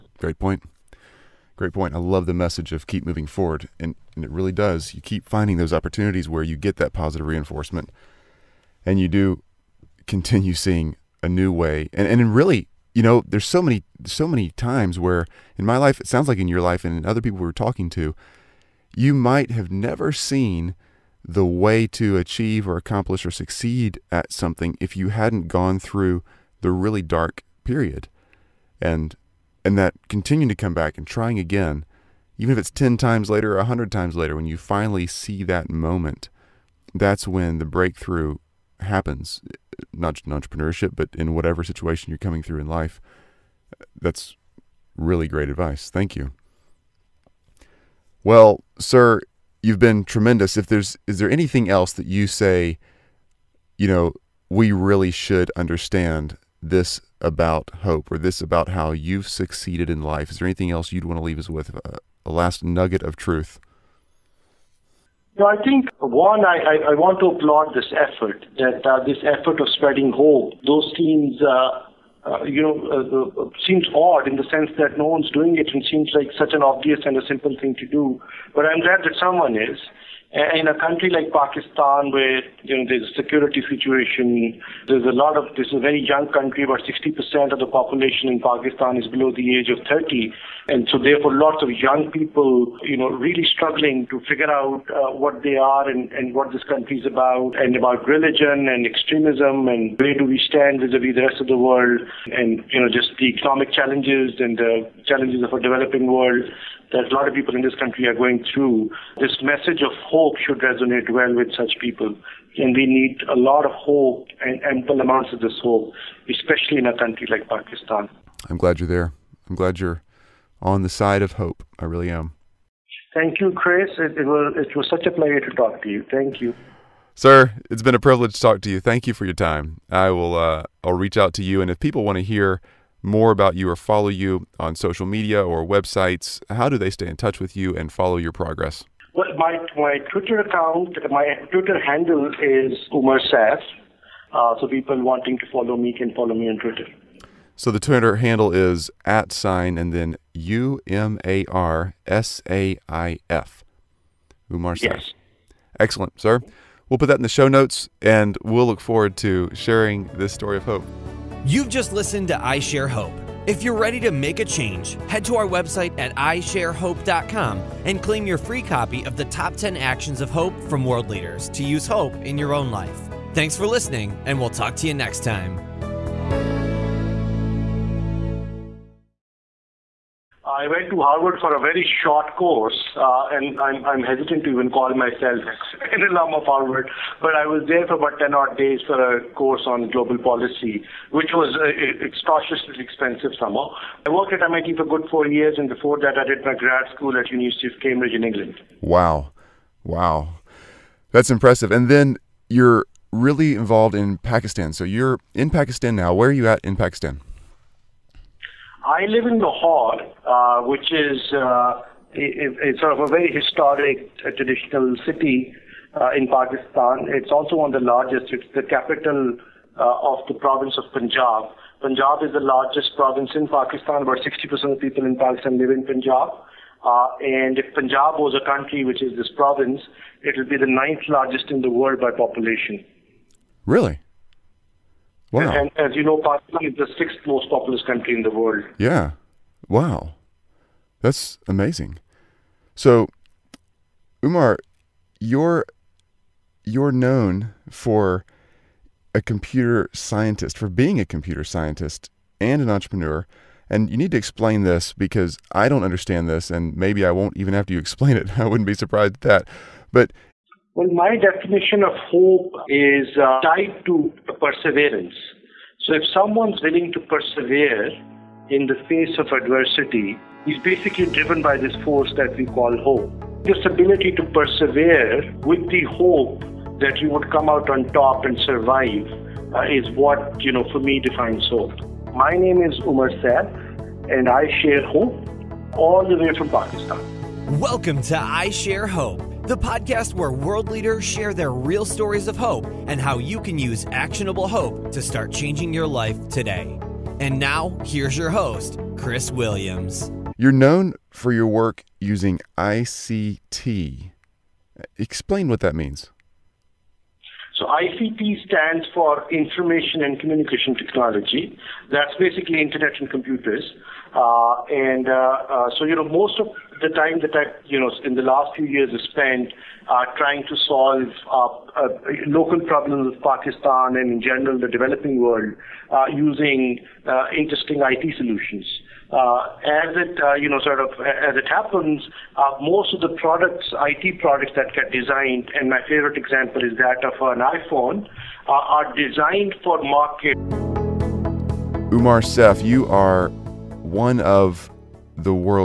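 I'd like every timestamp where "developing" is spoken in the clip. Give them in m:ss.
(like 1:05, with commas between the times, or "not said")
1:45, 5:24.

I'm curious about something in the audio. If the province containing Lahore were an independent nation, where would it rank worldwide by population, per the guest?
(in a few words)
ninth.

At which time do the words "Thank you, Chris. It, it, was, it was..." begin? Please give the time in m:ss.
2:03.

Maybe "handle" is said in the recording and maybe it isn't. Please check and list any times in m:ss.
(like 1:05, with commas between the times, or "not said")
2:21, 2:28.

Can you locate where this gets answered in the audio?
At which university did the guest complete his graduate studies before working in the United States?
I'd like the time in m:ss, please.
3:17.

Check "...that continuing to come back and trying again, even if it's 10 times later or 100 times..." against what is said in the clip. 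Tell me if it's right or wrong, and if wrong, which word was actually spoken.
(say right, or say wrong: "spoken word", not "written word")
right.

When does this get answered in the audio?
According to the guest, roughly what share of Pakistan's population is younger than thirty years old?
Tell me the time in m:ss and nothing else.
1:26.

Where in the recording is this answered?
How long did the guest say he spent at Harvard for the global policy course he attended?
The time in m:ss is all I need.
3:07.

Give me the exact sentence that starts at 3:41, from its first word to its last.
Punjab is the largest province in Pakistan.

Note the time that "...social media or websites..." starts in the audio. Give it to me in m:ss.
2:14.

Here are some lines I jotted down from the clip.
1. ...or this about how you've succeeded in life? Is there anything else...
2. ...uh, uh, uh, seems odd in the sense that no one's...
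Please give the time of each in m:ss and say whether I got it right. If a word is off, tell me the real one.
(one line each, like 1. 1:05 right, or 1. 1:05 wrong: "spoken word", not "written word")
1. 0:58 right
2. 1:13 right.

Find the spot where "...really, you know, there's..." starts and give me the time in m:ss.
0:12.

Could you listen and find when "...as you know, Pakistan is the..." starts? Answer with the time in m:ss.
3:55.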